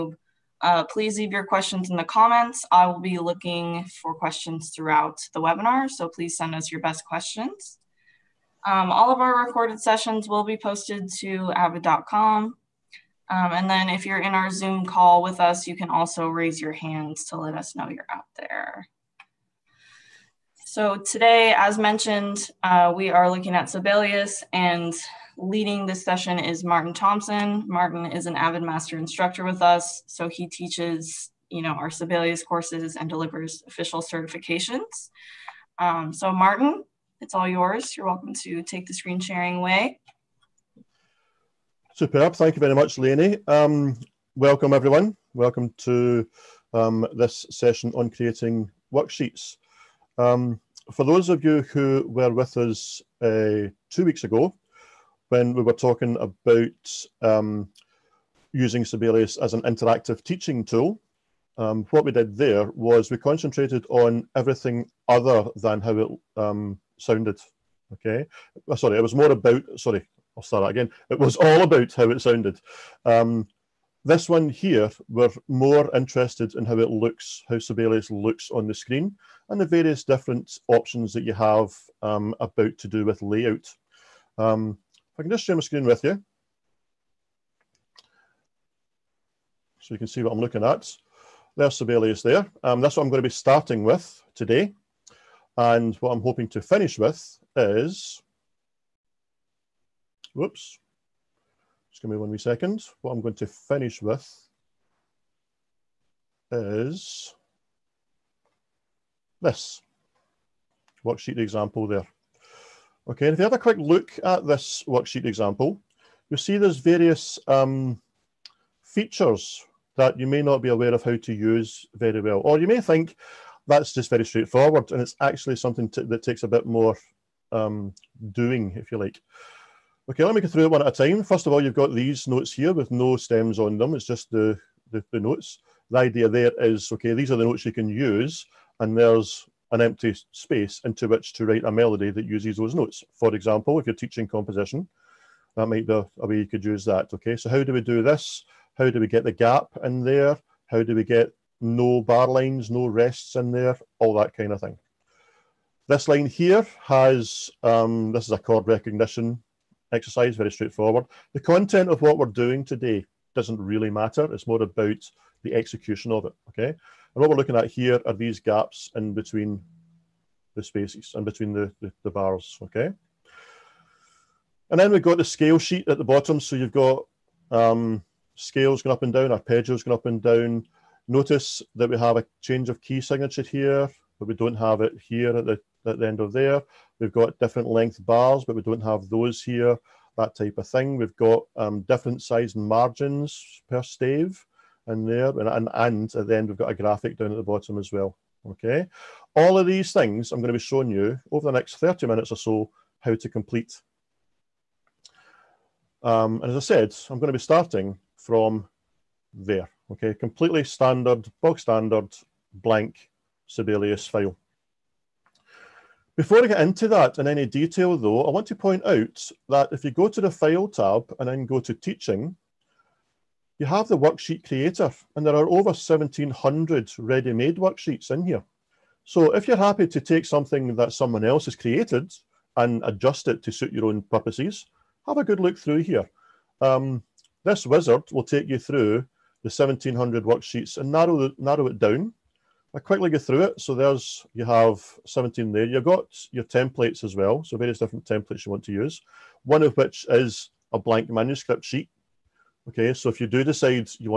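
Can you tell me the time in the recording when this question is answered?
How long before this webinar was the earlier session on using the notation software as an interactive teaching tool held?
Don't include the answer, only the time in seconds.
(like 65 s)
53 s.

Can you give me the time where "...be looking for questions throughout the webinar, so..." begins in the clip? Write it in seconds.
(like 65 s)
2 s.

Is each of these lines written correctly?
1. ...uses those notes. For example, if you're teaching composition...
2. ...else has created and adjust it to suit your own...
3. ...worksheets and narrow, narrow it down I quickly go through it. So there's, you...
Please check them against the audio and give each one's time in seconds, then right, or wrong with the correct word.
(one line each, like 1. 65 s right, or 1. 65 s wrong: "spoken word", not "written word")
1. 142 s right
2. 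231 s right
3. 240 s right.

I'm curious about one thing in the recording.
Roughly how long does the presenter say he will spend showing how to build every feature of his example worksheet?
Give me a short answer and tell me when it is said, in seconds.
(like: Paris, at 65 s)
30 minutes, at 201 s.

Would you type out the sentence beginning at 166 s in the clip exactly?
And what we're looking at here are these gaps in between the spaces, and between the, the, the bars, okay?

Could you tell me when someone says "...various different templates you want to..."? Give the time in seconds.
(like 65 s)
247 s.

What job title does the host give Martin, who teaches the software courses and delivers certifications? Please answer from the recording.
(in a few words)
Master instructor.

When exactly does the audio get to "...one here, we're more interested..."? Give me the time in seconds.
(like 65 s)
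74 s.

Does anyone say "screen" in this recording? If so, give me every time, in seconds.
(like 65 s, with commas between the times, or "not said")
38 s, 78 s, 85 s.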